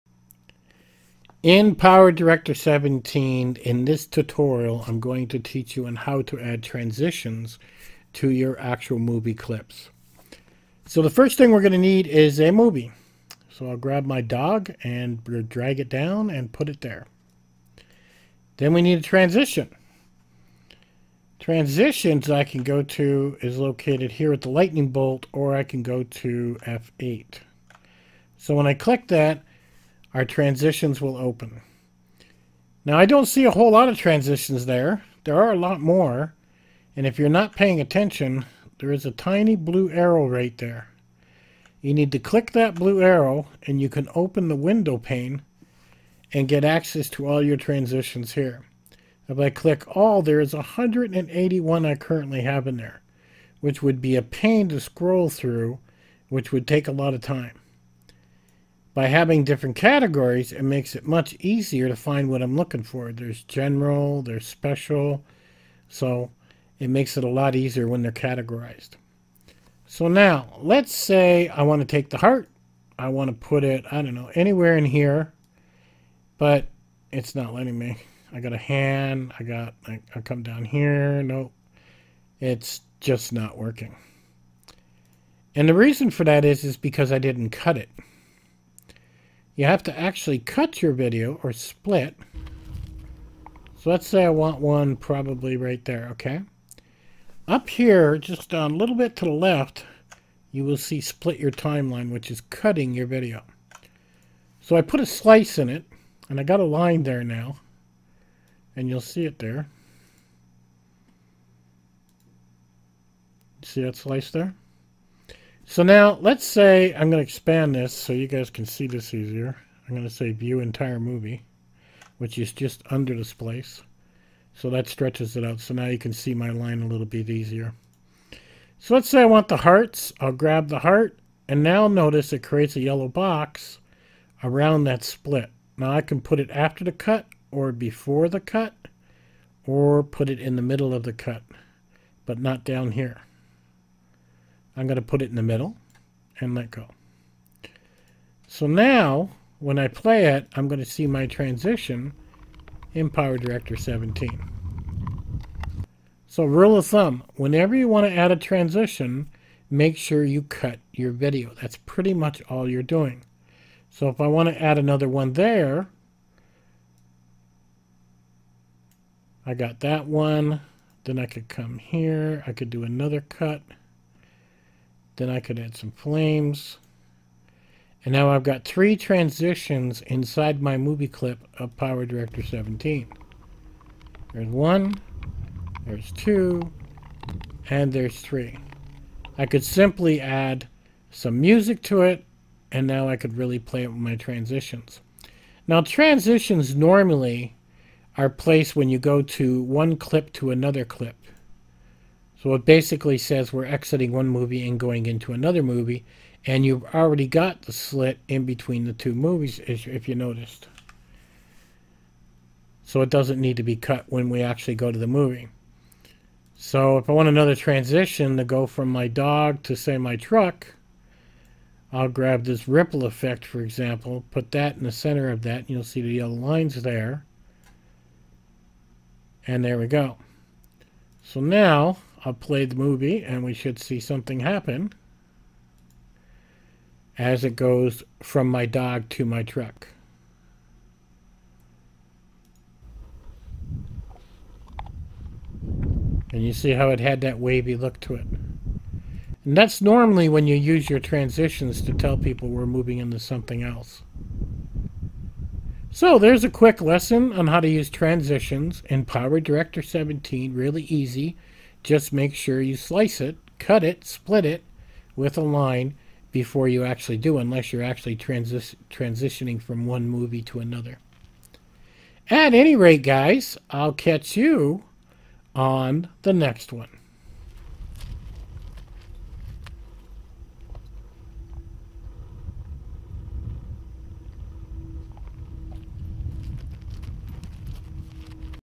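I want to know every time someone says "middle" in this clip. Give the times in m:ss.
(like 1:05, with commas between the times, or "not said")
2:20, 2:25.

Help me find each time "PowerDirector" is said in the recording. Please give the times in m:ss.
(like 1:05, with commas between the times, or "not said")
0:01, 2:33, 3:01, 4:19.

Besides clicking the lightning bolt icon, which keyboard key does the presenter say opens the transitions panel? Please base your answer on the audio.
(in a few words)
F8.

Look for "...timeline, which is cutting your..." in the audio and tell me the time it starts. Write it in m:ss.
1:41.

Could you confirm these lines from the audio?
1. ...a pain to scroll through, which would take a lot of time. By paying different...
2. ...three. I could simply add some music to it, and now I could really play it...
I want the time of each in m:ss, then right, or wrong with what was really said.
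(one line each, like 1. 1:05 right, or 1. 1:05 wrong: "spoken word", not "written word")
1. 0:54 wrong: "having", not "paying"
2. 3:08 right.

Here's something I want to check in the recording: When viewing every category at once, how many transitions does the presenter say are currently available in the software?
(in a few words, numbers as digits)
181.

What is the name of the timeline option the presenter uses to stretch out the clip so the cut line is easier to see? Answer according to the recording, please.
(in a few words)
View entire movie.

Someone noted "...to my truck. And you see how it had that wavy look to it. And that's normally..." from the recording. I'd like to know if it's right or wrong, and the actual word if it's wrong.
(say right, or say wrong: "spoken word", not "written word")
right.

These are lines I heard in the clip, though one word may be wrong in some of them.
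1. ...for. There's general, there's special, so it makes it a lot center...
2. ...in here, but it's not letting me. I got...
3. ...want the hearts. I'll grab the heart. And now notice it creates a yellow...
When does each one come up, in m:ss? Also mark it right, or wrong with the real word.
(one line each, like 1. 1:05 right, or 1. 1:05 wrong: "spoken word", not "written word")
1. 1:02 wrong: "easier", not "center"
2. 1:14 right
3. 2:09 right.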